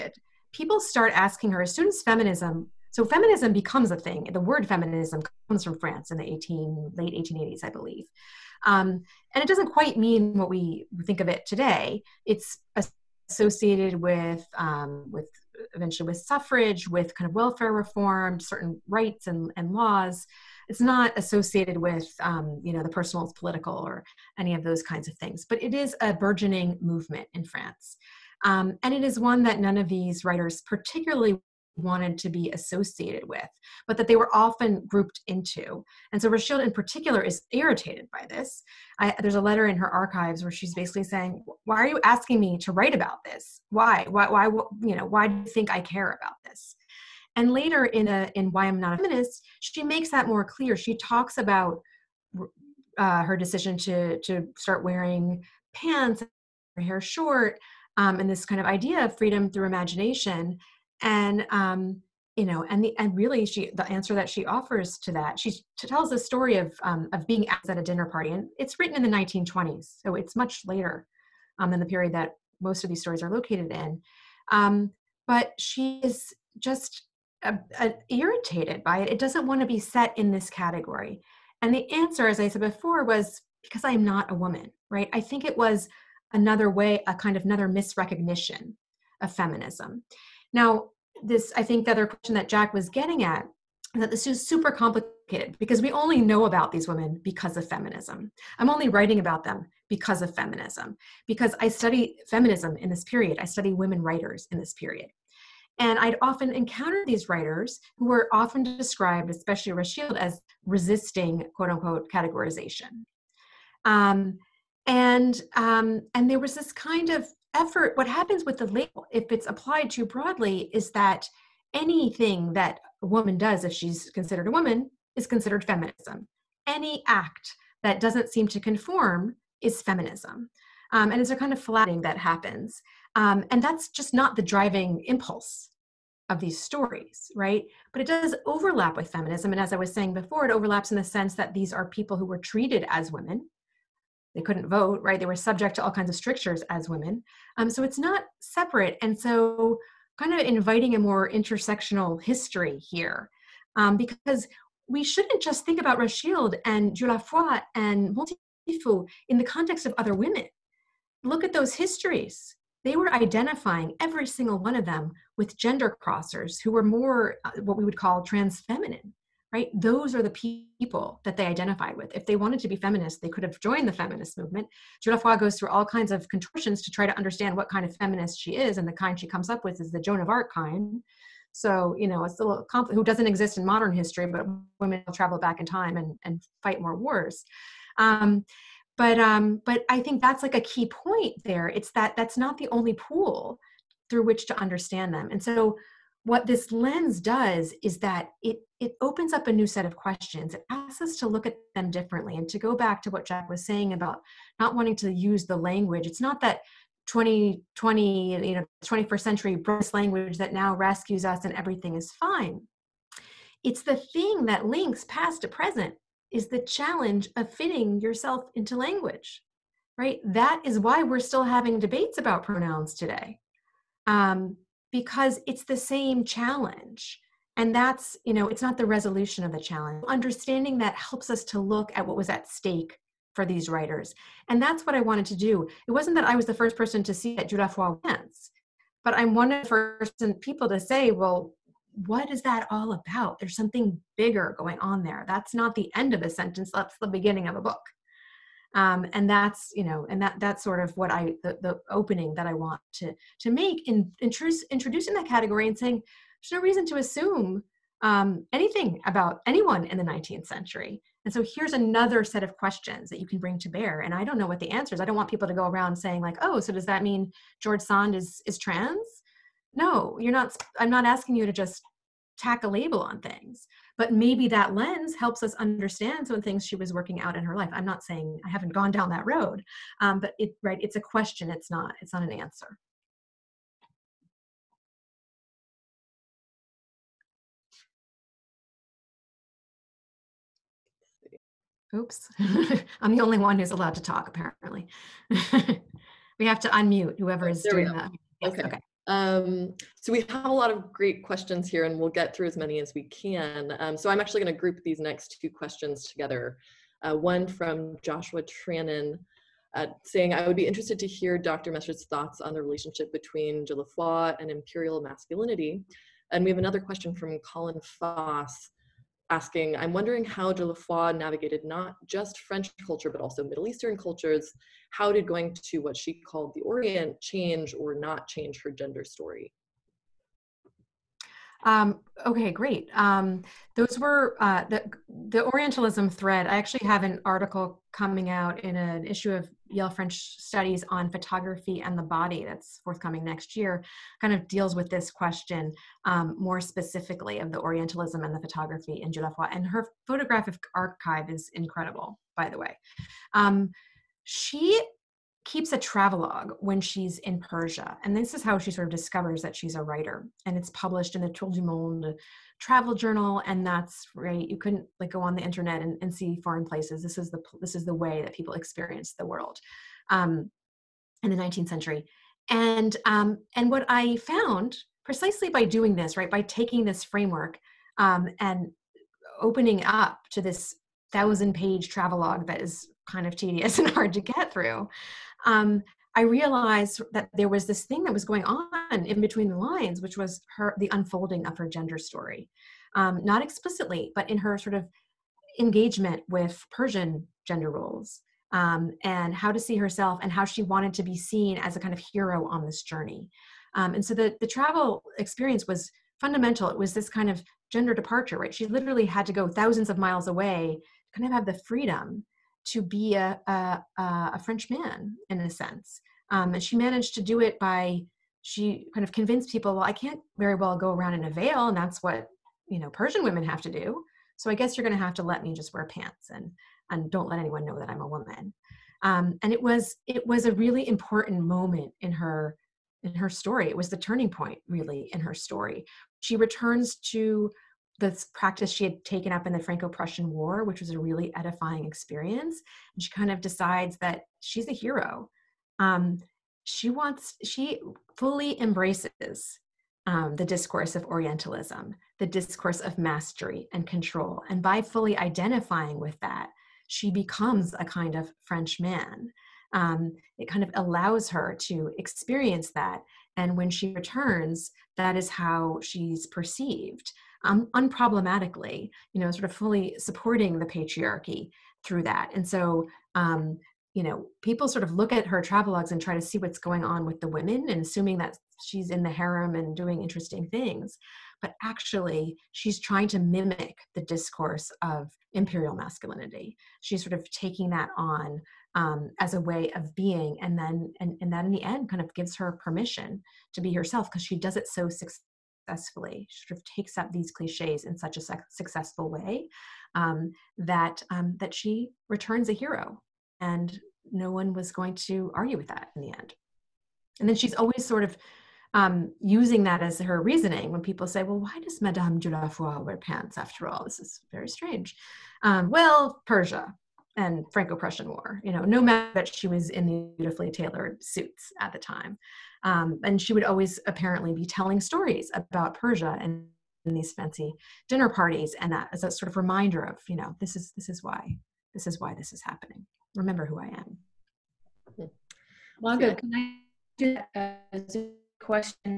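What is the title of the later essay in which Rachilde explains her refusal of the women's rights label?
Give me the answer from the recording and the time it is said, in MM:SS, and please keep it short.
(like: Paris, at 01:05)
Why I'm Not a Feminist, at 00:48.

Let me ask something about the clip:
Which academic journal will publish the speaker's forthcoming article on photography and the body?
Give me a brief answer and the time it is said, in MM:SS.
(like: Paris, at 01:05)
Yale French Studies, at 05:39.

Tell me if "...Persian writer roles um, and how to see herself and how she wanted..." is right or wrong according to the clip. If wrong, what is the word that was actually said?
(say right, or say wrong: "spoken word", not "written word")
wrong: "gender", not "writer".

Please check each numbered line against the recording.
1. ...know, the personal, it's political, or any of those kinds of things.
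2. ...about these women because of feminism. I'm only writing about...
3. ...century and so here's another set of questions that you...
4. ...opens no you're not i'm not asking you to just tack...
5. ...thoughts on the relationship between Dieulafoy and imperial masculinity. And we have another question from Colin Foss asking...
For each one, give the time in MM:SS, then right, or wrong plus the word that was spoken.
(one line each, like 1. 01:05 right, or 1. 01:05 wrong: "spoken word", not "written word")
1. 00:22 right
2. 01:36 right
3. 04:20 right
4. 04:28 wrong: "trans", not "opens"
5. 05:12 right.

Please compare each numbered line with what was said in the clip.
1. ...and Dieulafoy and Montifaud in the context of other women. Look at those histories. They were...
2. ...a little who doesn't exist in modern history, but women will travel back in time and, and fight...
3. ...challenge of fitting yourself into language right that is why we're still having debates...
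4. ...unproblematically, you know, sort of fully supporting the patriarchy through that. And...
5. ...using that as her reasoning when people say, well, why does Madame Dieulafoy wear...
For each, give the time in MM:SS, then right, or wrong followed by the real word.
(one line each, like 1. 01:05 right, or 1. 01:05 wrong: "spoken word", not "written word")
1. 02:36 right
2. 03:02 right
3. 03:36 right
4. 07:47 right
5. 08:29 right.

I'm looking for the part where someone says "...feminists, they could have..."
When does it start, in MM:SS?
02:52.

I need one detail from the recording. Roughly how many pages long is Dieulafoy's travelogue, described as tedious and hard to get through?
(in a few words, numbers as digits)
1000.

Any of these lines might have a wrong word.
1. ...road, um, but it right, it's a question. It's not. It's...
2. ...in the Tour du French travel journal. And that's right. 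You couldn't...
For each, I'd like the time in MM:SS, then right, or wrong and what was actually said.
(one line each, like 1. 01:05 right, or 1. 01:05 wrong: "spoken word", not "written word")
1. 04:39 right
2. 06:01 wrong: "Monde", not "French".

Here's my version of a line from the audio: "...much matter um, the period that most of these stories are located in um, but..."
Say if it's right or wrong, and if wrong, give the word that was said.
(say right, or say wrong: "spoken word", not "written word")
wrong: "later", not "matter".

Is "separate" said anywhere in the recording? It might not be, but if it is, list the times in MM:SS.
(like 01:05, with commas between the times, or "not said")
02:28.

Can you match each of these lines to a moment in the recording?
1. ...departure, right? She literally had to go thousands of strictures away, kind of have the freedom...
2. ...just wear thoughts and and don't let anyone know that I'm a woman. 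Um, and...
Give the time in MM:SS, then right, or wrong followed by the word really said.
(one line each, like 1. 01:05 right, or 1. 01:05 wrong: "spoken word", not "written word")
1. 06:47 wrong: "miles", not "strictures"
2. 07:05 wrong: "pants", not "thoughts".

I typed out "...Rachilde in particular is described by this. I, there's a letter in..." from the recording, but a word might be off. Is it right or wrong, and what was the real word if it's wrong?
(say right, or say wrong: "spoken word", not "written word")
wrong: "irritated", not "described".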